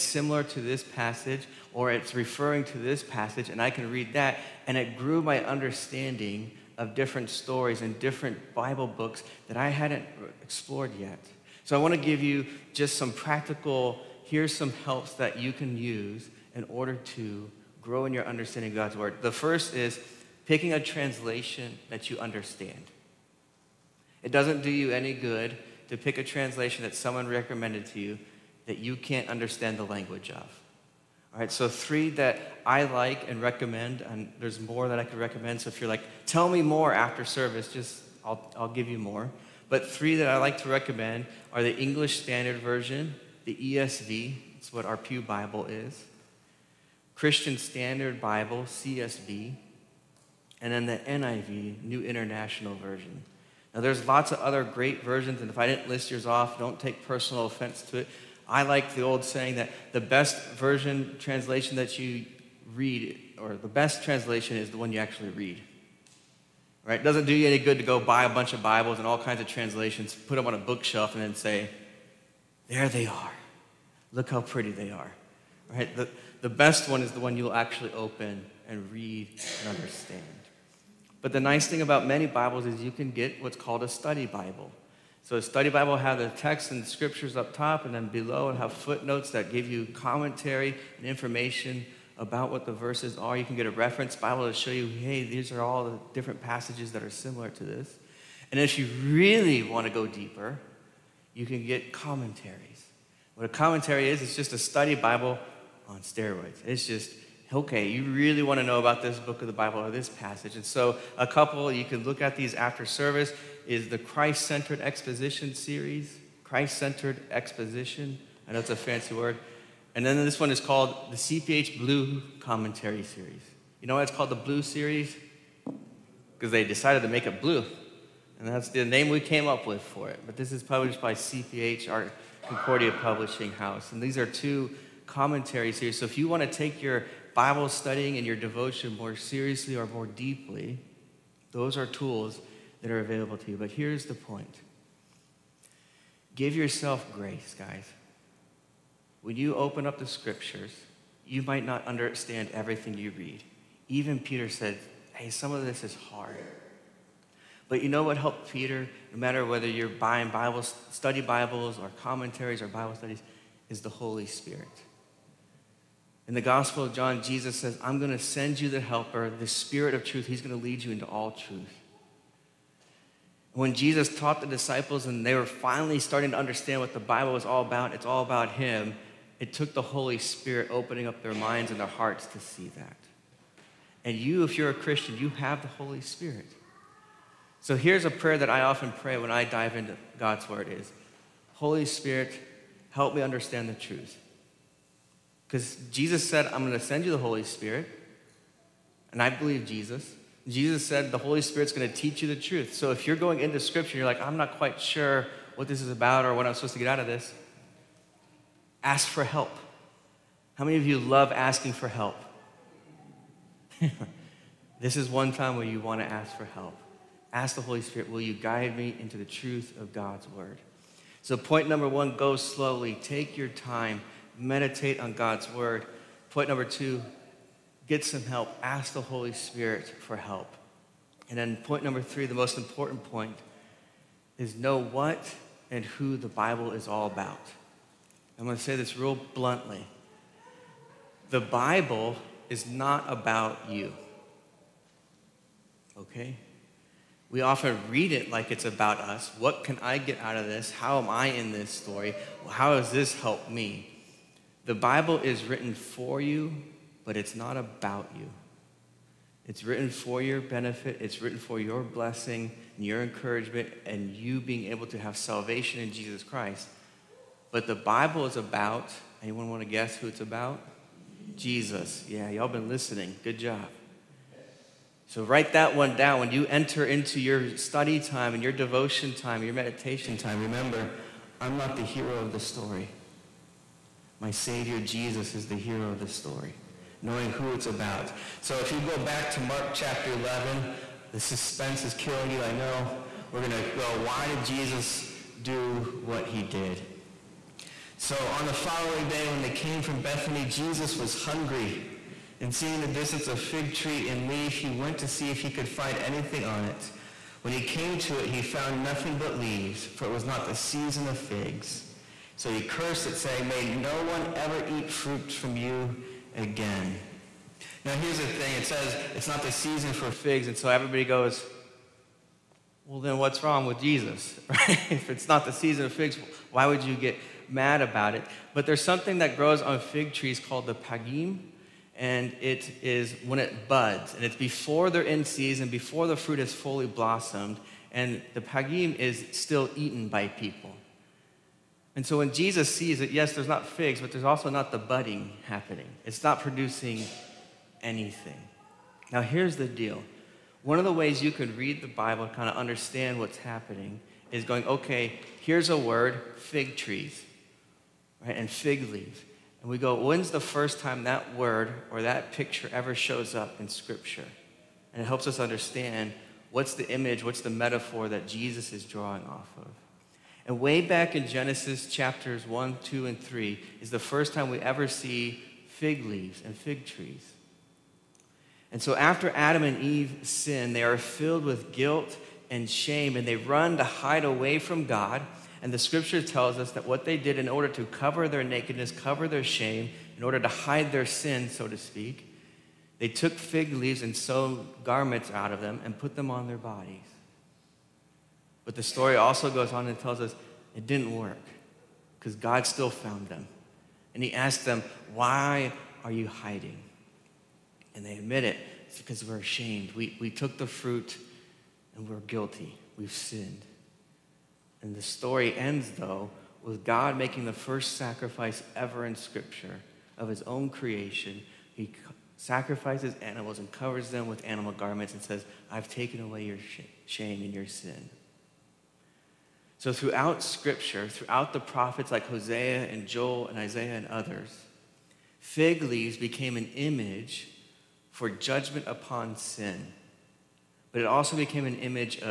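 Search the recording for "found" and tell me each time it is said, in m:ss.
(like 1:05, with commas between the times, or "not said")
5:08, 6:42.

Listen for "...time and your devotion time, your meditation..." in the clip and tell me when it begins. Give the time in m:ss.
4:38.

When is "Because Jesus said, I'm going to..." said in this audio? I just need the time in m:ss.
3:15.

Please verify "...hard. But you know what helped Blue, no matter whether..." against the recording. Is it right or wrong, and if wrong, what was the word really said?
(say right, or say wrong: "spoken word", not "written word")
wrong: "Peter", not "Blue".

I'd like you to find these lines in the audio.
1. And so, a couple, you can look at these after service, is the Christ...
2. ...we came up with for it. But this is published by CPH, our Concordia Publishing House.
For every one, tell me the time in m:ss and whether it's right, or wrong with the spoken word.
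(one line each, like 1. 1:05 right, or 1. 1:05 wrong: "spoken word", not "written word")
1. 1:50 right
2. 2:09 right.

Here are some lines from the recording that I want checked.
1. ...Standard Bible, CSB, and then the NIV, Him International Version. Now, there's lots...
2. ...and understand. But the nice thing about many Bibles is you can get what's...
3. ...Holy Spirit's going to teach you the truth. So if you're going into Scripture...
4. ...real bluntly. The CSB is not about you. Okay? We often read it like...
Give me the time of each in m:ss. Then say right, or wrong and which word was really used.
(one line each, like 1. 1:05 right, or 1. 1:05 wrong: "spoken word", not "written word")
1. 0:47 wrong: "New", not "Him"
2. 1:19 right
3. 3:21 right
4. 3:58 wrong: "Bible", not "CSB".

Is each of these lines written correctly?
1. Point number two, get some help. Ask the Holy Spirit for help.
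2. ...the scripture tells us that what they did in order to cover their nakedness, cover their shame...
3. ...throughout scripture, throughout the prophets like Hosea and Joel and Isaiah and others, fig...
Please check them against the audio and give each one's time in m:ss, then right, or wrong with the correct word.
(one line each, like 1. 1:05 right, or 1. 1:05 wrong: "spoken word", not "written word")
1. 3:46 right
2. 6:25 right
3. 7:09 right.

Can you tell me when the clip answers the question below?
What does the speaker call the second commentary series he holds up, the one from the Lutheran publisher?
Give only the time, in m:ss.
2:01.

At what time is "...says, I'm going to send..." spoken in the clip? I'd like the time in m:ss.
2:47.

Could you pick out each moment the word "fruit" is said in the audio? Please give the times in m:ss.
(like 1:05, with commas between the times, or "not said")
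5:14, 5:36, 6:50.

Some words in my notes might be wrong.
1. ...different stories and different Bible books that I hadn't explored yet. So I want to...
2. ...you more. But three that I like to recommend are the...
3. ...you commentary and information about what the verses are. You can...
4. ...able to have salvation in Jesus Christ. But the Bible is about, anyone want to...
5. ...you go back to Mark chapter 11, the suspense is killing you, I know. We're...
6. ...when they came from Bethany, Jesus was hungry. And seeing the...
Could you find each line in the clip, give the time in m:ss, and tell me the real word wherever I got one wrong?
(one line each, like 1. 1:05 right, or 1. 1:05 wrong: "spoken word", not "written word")
1. 0:06 right
2. 0:38 right
3. 1:29 right
4. 4:24 right
5. 4:48 right
6. 4:59 right.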